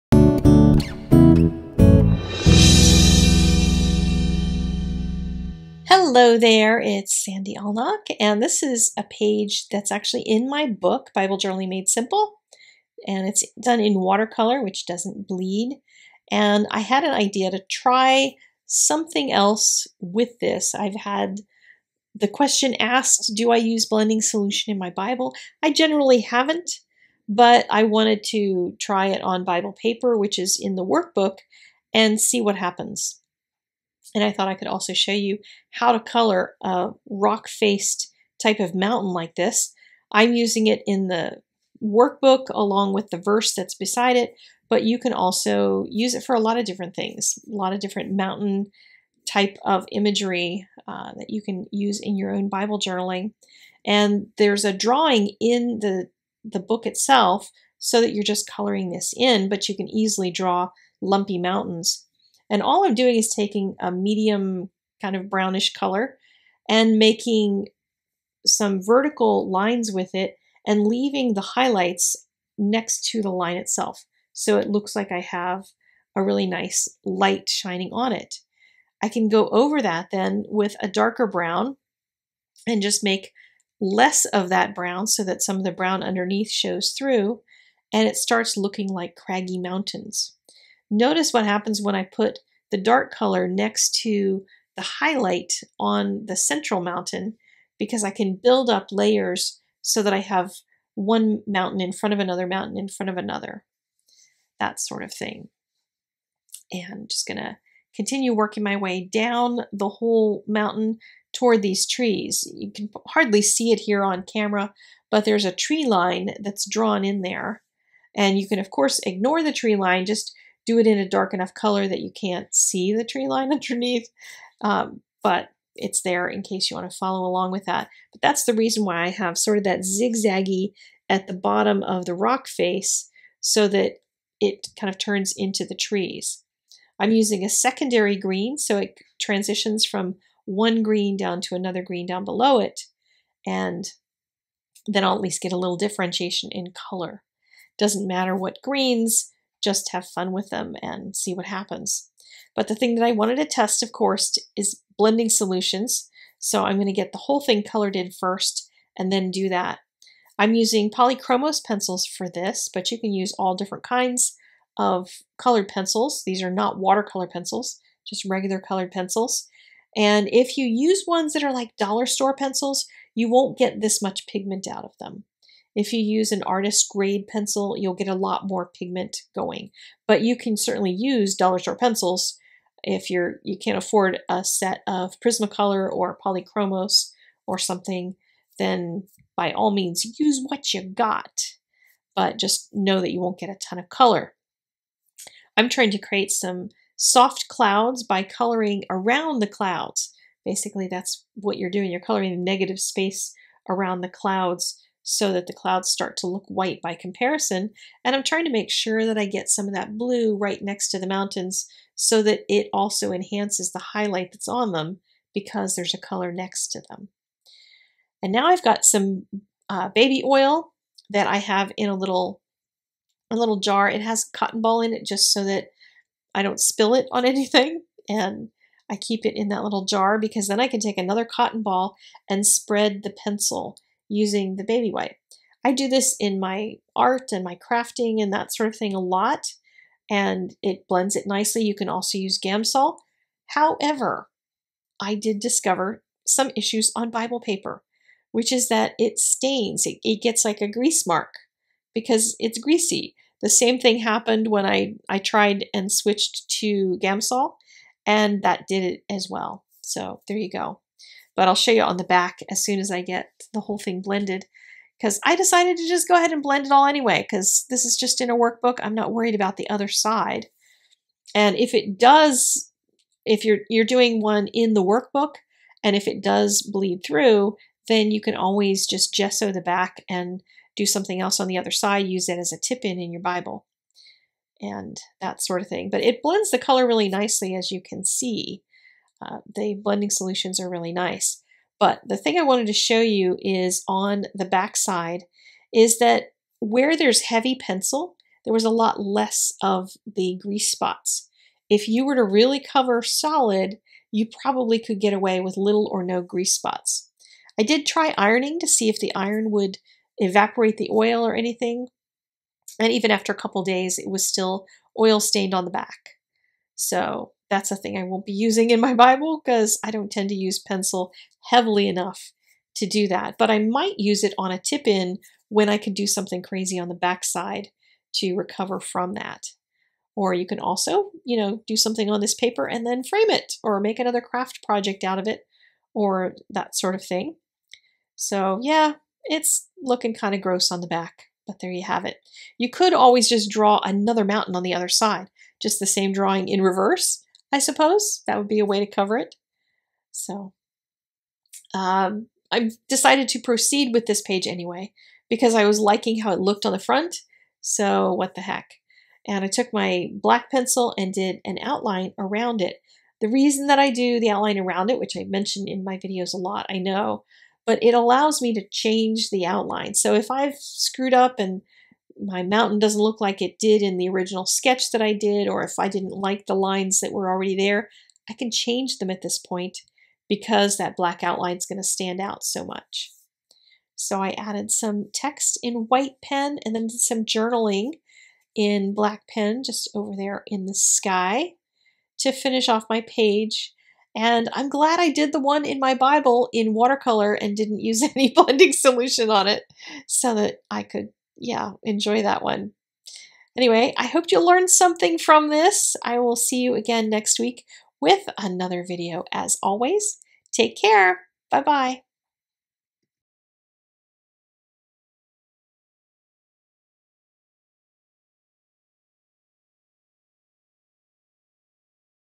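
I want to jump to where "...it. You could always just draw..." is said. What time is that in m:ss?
5:42.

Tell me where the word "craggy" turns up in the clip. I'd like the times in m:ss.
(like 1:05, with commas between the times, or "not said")
1:29.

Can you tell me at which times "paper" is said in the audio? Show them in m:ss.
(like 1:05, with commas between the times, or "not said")
0:29, 4:07, 5:32.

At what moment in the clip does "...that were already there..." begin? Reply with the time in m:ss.
6:16.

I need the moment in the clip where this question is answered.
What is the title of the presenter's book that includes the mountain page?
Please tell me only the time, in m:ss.
0:11.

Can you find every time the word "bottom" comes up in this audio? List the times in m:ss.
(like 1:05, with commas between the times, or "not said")
2:11.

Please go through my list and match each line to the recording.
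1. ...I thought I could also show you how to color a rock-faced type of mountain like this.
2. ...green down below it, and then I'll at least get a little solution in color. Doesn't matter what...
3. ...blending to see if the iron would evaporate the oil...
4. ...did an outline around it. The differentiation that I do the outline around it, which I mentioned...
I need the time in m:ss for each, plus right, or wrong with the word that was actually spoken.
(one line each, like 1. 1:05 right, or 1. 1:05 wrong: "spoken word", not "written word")
1. 0:34 right
2. 2:21 wrong: "differentiation", not "solution"
3. 5:08 wrong: "ironing", not "blending"
4. 6:01 wrong: "reason", not "differentiation".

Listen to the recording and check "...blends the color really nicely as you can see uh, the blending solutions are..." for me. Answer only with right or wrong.
right.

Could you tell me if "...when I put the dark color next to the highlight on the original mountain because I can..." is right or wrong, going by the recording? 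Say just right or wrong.
wrong.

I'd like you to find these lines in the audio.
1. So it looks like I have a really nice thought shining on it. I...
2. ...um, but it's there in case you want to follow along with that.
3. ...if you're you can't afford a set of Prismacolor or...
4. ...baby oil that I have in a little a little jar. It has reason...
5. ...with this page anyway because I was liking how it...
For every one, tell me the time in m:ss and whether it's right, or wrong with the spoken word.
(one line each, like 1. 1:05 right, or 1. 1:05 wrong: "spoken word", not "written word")
1. 1:14 wrong: "light", not "thought"
2. 2:04 right
3. 3:02 right
4. 3:39 wrong: "cotton", not "reason"
5. 5:53 right.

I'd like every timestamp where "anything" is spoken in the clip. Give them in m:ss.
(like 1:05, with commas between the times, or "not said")
3:47, 5:11.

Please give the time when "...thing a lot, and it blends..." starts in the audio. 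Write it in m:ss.
3:58.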